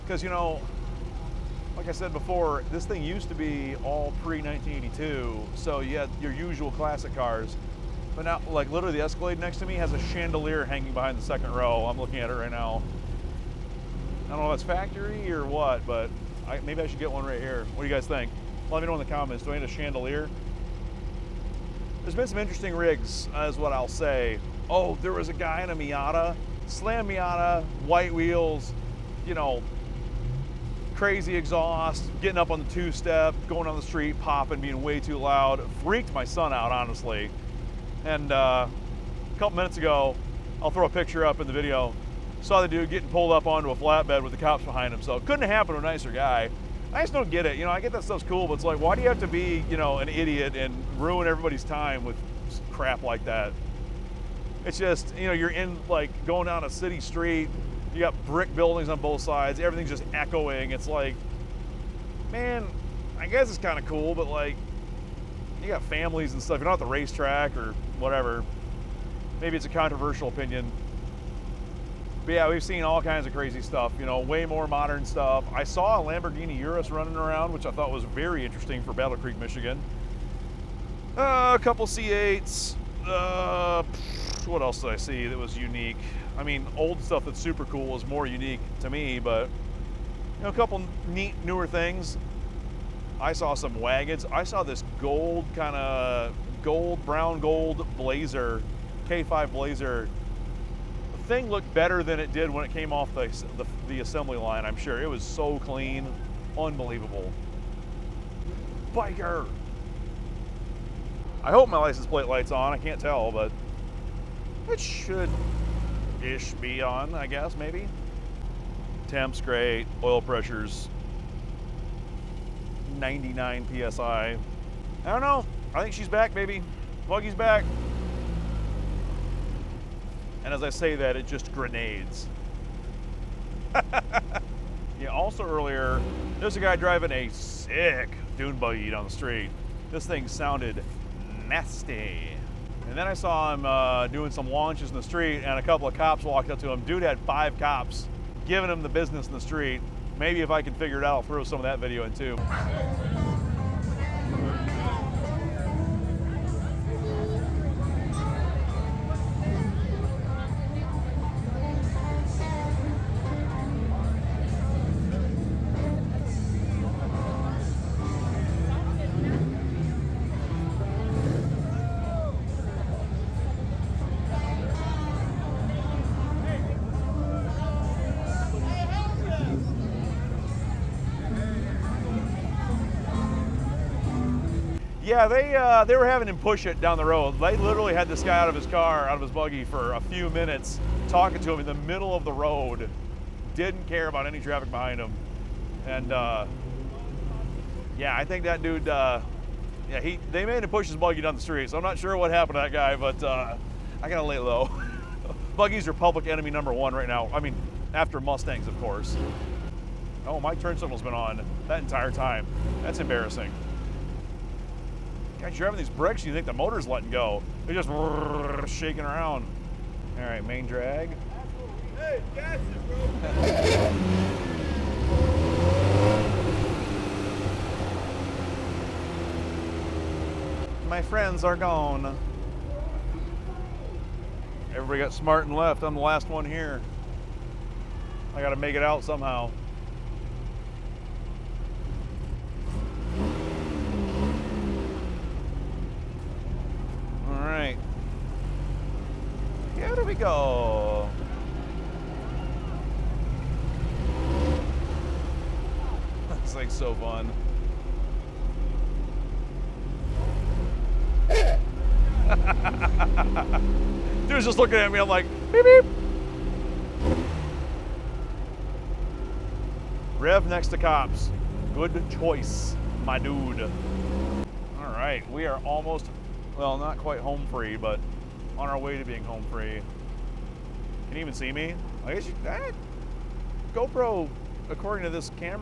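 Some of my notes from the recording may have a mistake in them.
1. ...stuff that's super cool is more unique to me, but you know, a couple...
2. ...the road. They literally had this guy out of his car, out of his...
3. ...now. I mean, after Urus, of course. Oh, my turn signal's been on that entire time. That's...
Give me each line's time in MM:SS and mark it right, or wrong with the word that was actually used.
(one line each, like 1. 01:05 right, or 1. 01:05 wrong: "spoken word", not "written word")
1. 01:27 right
2. 03:06 right
3. 03:27 wrong: "Mustangs", not "Urus".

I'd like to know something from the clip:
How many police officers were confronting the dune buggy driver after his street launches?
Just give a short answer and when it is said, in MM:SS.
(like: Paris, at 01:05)
5, at 02:27.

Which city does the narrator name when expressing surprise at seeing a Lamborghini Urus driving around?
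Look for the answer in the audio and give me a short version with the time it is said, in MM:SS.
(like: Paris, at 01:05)
Battle Creek, Michigan, at 01:18.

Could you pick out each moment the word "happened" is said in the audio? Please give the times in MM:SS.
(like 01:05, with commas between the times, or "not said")
00:45, 03:22.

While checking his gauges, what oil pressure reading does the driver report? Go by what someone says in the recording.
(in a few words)
99 PSI.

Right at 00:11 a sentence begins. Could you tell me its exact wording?
I'm looking at it right now.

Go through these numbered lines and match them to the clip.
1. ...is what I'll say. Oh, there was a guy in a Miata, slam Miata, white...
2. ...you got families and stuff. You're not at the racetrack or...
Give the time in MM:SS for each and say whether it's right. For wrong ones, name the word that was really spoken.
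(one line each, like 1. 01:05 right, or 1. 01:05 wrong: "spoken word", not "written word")
1. 00:23 right
2. 01:05 right.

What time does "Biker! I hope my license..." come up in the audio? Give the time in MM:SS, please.
01:48.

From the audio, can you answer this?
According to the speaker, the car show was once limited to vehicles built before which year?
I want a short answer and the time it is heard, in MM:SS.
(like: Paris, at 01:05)
1982, at 00:04.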